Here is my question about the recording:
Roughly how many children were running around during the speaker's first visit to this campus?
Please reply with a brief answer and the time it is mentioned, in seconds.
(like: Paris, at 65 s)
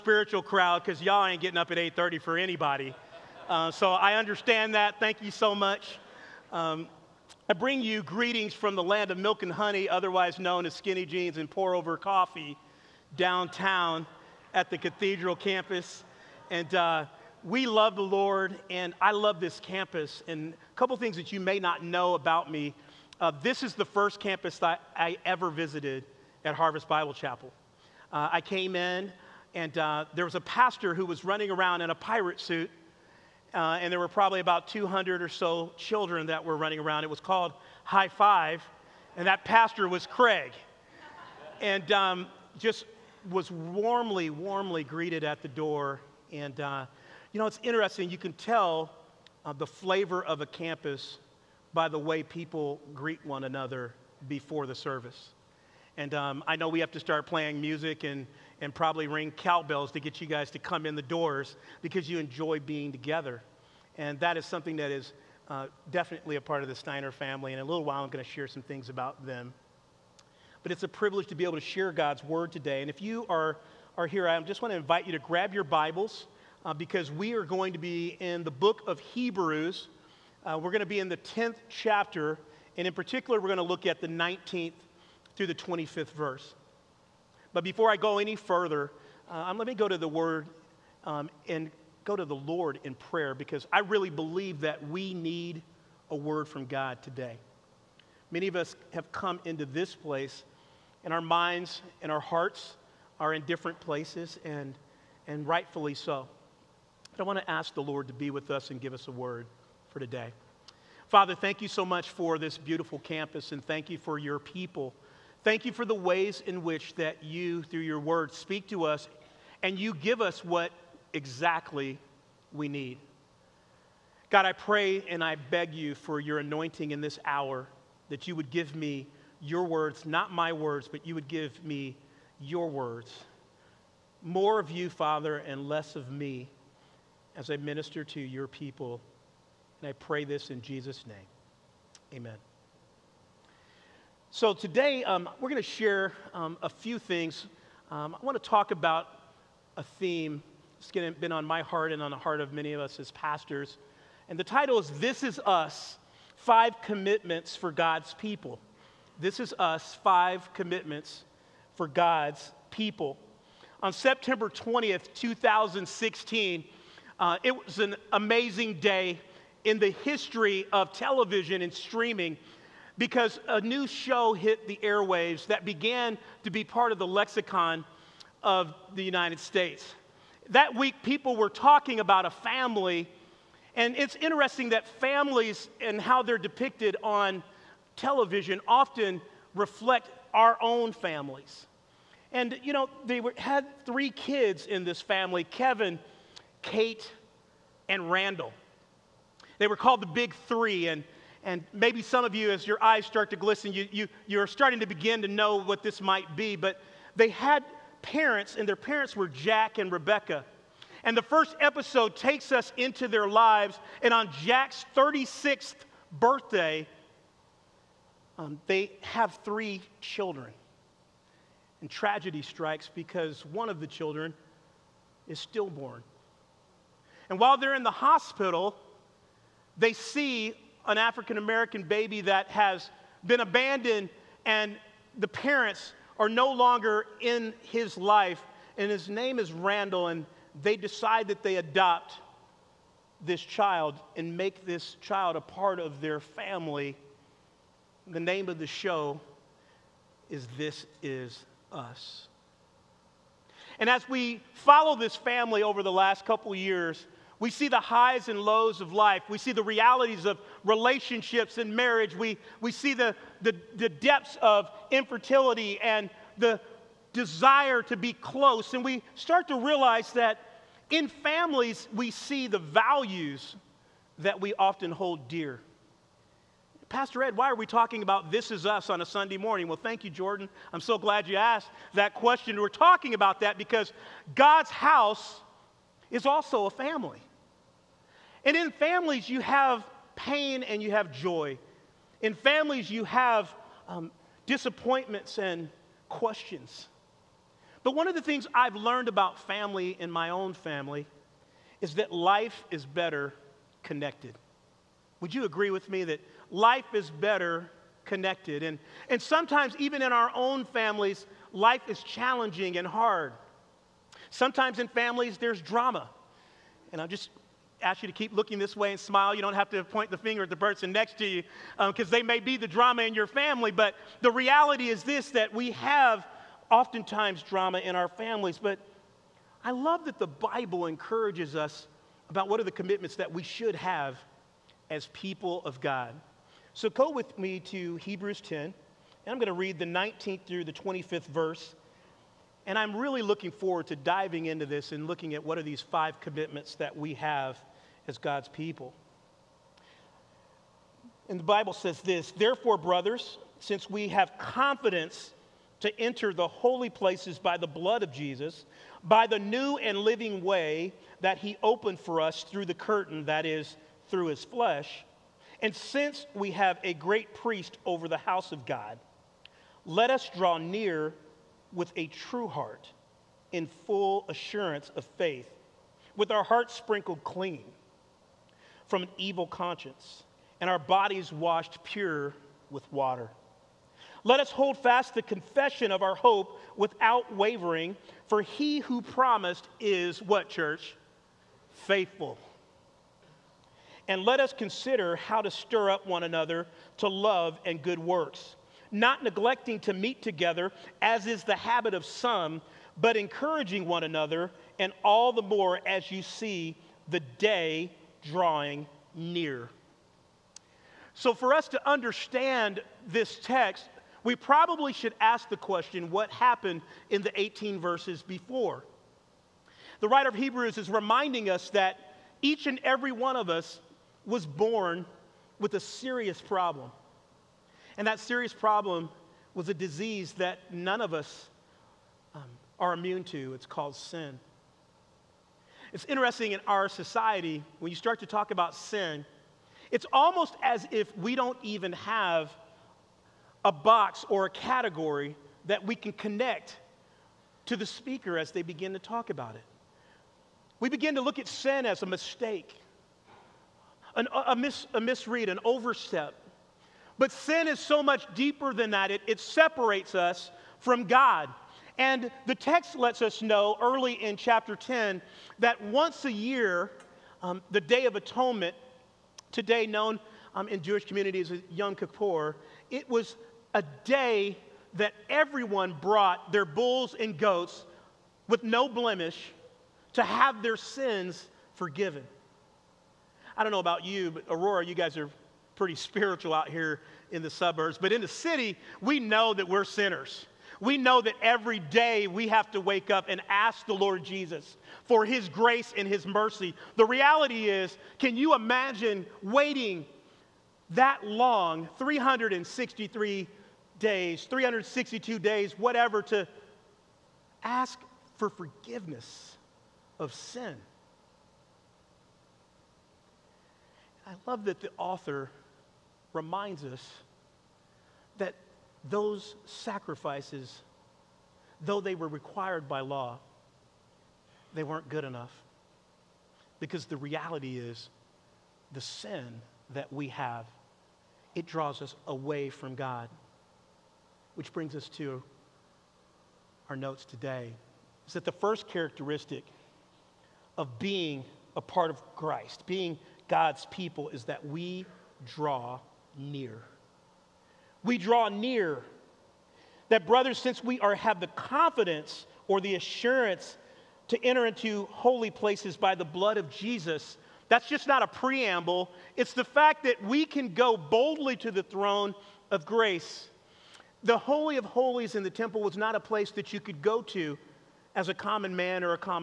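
200, at 34 s.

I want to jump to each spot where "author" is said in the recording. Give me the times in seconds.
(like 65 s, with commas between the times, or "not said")
514 s.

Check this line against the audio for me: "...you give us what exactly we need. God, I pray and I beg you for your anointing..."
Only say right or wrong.
right.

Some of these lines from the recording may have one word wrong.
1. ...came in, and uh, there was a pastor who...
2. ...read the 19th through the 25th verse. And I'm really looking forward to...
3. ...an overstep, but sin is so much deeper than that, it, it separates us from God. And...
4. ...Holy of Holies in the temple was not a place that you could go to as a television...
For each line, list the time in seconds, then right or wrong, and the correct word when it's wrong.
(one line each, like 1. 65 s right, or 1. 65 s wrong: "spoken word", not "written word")
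1. 28 s right
2. 339 s right
3. 455 s right
4. 564 s wrong: "common", not "television".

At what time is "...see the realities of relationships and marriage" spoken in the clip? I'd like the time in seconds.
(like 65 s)
259 s.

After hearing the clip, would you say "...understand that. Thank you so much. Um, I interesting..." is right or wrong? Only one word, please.
wrong.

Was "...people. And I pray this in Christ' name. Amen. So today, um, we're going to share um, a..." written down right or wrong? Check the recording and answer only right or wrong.
wrong.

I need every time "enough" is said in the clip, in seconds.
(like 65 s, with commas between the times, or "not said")
525 s.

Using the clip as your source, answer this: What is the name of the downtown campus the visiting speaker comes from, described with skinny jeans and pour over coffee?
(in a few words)
cathedral campus.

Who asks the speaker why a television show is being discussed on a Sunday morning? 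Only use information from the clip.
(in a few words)
Jordan.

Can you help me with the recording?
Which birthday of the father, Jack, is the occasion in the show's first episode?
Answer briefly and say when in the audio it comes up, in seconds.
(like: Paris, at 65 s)
36th, at 214 s.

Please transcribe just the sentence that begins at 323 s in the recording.
But the reality is this that we have oftentimes drama in our families.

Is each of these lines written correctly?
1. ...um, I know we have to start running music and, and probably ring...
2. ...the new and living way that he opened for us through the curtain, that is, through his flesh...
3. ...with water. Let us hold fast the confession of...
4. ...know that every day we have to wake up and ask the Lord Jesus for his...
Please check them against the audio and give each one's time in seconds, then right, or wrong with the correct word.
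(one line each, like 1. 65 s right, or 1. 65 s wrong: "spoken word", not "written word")
1. 56 s wrong: "playing", not "running"
2. 359 s right
3. 382 s right
4. 490 s right.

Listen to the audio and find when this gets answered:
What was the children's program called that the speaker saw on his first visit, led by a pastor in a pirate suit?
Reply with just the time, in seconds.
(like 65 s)
37 s.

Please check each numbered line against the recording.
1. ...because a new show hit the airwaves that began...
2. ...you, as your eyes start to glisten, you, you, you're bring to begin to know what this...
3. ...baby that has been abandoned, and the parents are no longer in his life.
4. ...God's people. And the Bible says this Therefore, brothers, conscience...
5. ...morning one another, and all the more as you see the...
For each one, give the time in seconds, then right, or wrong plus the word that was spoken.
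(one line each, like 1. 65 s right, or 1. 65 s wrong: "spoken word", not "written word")
1. 172 s right
2. 202 s wrong: "starting", not "bring"
3. 231 s right
4. 348 s wrong: "since", not "conscience"
5. 403 s wrong: "encouraging", not "morning".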